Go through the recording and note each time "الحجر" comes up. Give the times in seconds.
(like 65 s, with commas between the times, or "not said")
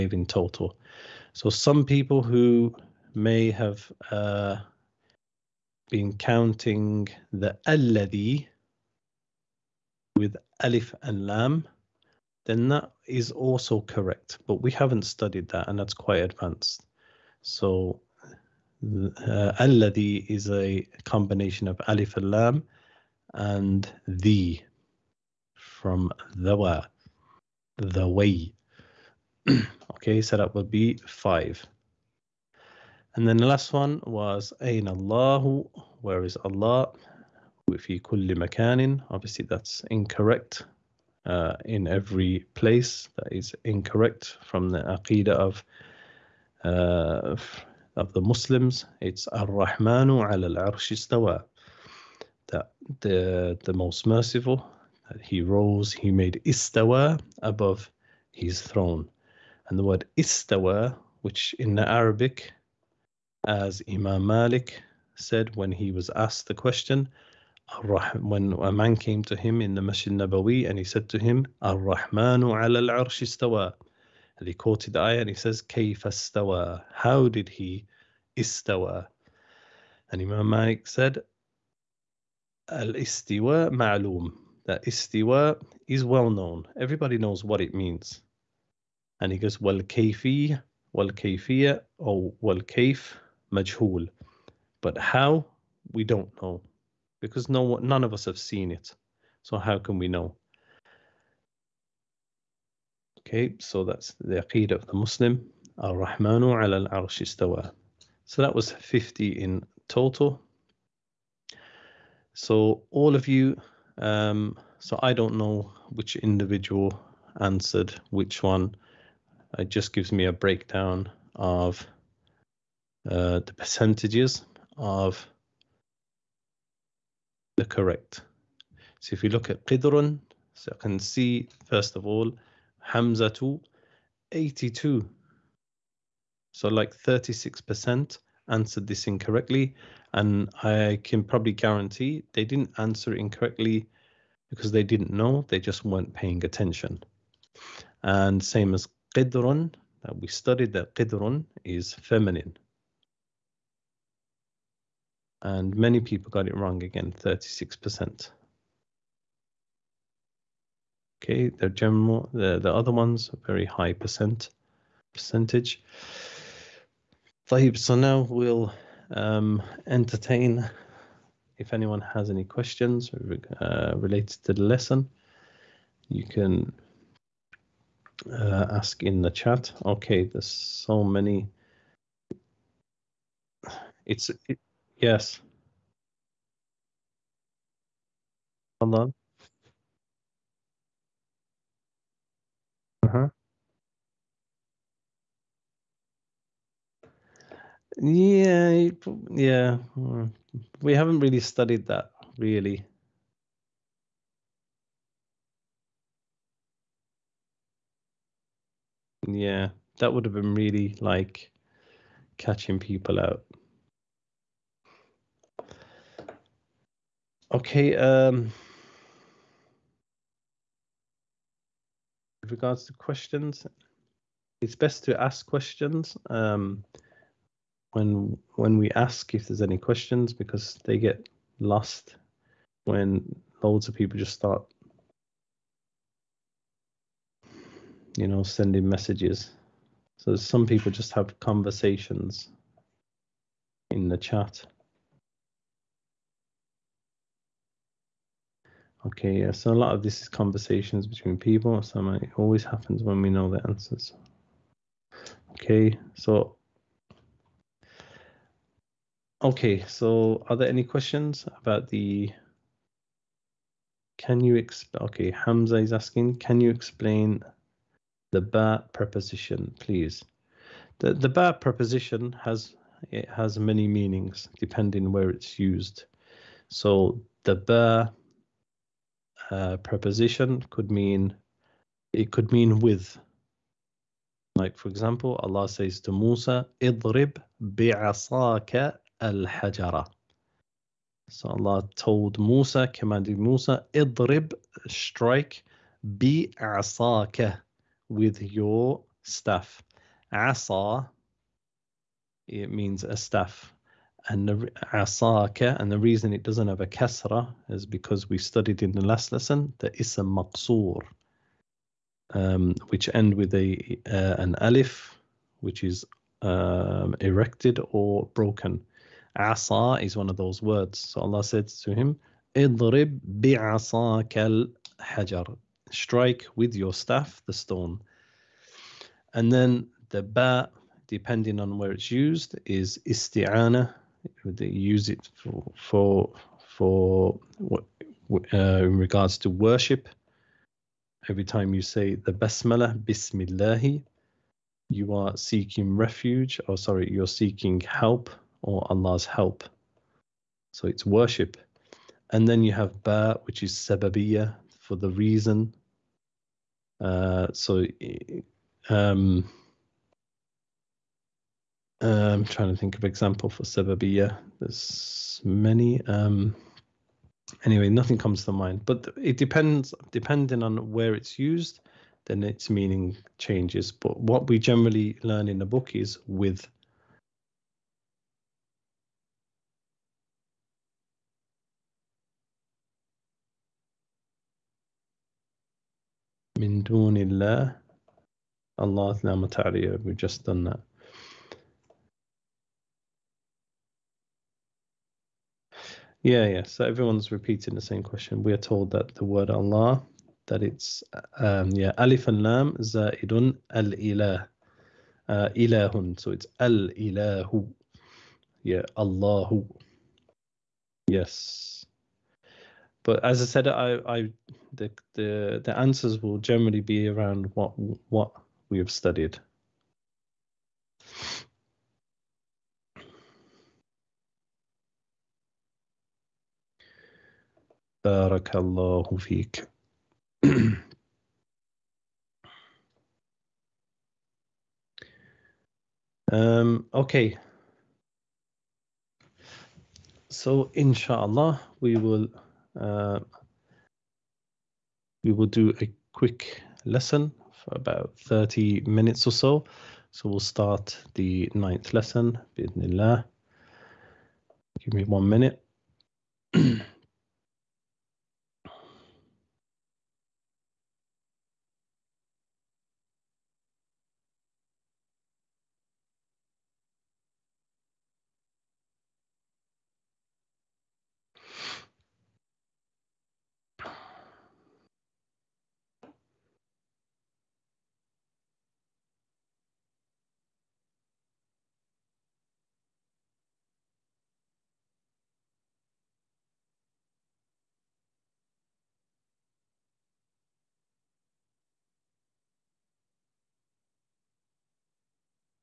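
325 s.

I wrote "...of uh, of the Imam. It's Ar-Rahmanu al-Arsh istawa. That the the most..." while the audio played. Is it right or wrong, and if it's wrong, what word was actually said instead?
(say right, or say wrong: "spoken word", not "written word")
wrong: "Muslims", not "Imam".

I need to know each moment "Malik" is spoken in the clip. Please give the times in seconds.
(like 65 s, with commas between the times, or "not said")
64 s, 80 s.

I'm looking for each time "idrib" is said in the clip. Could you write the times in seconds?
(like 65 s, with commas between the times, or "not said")
286 s, 293 s.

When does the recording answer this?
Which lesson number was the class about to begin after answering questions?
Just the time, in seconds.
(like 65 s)
451 s.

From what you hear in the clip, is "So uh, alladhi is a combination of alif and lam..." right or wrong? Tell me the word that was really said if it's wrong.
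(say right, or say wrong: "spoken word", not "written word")
right.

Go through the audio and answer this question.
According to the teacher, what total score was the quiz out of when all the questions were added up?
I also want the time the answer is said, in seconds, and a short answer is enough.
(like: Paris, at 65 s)
50, at 108 s.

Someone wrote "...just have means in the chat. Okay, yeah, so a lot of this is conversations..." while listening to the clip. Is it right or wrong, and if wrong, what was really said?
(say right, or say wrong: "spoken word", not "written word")
wrong: "conversations", not "means".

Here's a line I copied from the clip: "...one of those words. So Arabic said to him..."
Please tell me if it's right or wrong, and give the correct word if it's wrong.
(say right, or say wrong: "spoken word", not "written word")
wrong: "Allah", not "Arabic".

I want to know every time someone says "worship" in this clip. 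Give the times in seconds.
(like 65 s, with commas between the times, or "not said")
339 s, 351 s.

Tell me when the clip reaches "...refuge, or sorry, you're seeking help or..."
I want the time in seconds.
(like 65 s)
345 s.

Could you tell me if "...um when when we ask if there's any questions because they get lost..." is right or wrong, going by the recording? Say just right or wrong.
right.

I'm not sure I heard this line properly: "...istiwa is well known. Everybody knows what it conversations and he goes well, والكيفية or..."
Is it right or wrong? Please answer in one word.
wrong.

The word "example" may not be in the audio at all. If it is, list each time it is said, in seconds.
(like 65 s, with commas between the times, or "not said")
284 s, 363 s.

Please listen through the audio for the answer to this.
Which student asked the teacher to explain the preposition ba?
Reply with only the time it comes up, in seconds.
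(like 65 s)
265 s.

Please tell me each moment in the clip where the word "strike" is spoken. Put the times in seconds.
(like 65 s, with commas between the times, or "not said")
294 s, 325 s.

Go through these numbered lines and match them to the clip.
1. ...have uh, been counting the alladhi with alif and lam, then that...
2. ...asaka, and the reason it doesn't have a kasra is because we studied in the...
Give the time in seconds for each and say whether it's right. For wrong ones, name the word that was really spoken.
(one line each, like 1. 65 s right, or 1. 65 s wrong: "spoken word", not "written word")
1. 3 s right
2. 304 s right.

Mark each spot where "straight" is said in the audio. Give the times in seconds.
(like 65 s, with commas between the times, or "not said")
not said.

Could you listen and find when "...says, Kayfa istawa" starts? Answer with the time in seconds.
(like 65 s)
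75 s.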